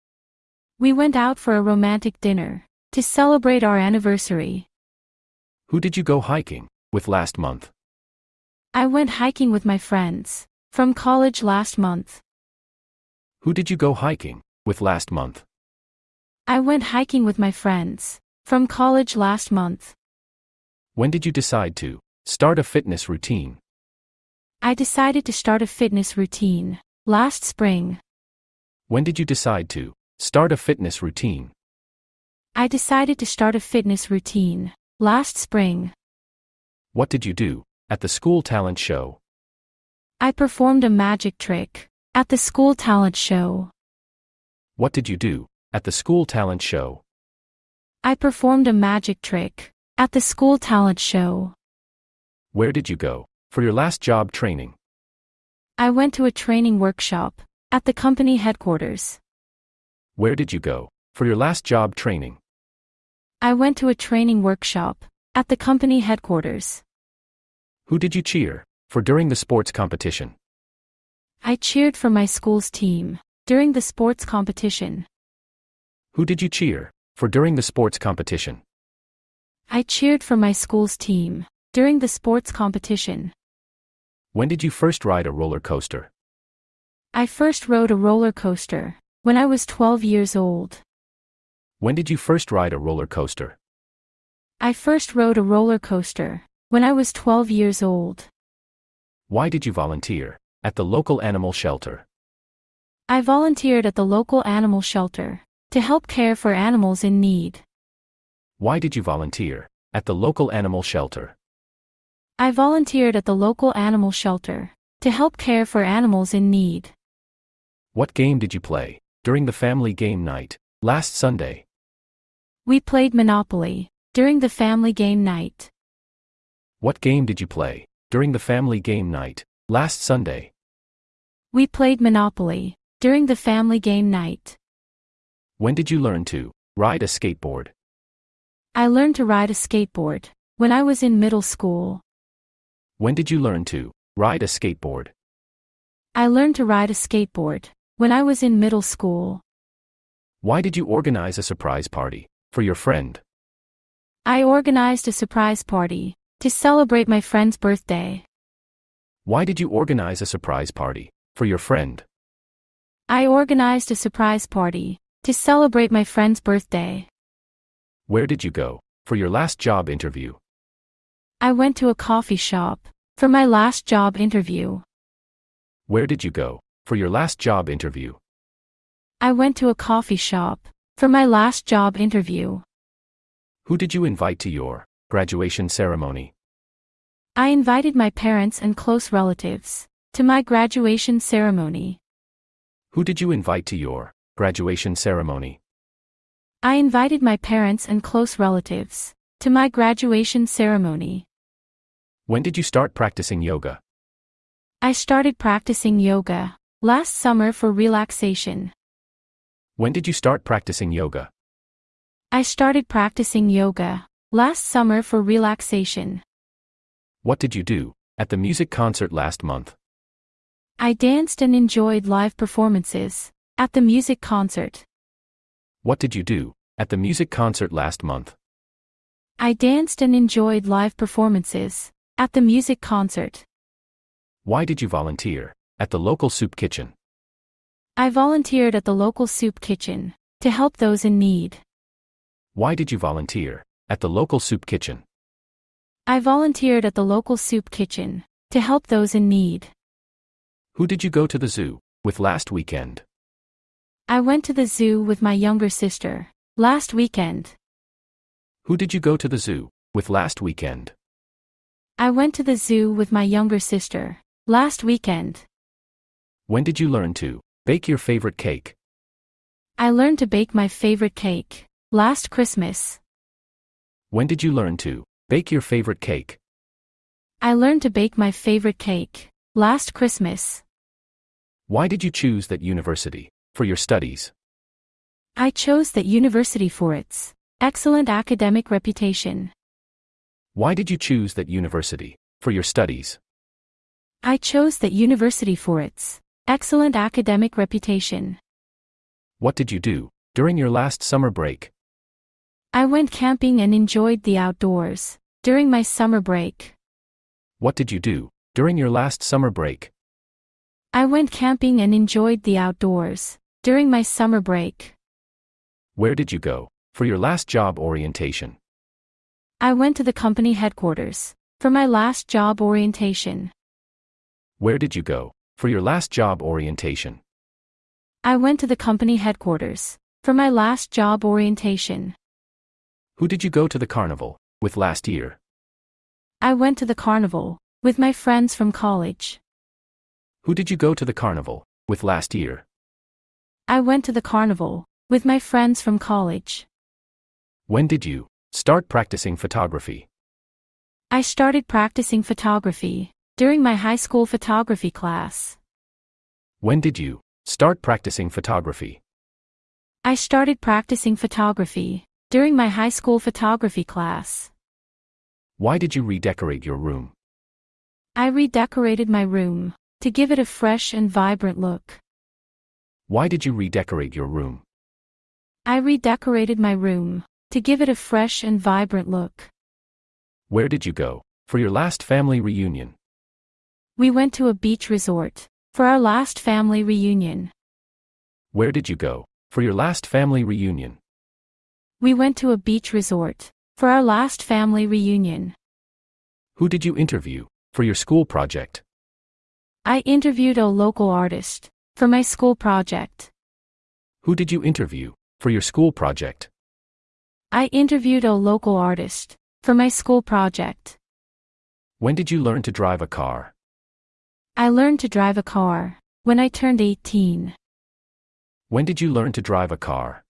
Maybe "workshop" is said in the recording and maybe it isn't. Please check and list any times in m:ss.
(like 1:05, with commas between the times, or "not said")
0:56, 1:04.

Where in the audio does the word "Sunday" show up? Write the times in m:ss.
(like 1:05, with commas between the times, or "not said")
2:01, 2:10.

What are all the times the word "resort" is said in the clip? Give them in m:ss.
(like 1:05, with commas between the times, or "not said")
6:24, 6:32.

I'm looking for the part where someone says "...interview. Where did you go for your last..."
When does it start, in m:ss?
2:54.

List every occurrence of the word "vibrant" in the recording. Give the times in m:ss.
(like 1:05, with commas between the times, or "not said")
6:11, 6:18.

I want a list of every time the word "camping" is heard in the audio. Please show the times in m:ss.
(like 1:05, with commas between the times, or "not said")
5:03, 5:11.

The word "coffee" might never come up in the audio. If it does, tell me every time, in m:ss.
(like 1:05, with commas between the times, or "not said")
2:51, 2:59.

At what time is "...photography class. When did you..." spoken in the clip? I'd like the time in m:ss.
5:54.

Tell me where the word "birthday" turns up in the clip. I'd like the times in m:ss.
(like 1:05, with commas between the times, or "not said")
2:37, 2:46.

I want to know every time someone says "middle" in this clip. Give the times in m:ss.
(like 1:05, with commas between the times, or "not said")
2:21, 2:28.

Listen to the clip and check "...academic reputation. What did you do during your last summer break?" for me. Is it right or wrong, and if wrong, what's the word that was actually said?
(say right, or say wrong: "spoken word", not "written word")
right.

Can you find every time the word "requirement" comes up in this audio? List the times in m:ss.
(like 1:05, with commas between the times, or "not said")
not said.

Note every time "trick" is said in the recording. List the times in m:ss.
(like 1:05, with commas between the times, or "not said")
0:41, 0:49.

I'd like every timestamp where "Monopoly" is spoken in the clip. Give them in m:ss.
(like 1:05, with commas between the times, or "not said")
2:03, 2:12.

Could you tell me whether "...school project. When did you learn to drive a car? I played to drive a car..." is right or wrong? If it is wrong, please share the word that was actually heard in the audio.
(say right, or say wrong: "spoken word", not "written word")
wrong: "learned", not "played".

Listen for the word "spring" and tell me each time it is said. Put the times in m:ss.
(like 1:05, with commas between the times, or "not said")
0:27, 0:35.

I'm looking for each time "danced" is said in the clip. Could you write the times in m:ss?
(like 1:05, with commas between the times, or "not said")
3:40, 3:49.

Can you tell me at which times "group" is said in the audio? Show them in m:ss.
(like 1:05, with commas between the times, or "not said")
not said.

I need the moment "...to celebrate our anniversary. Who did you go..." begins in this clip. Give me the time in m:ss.
0:02.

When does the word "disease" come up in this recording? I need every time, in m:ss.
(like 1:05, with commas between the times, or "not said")
not said.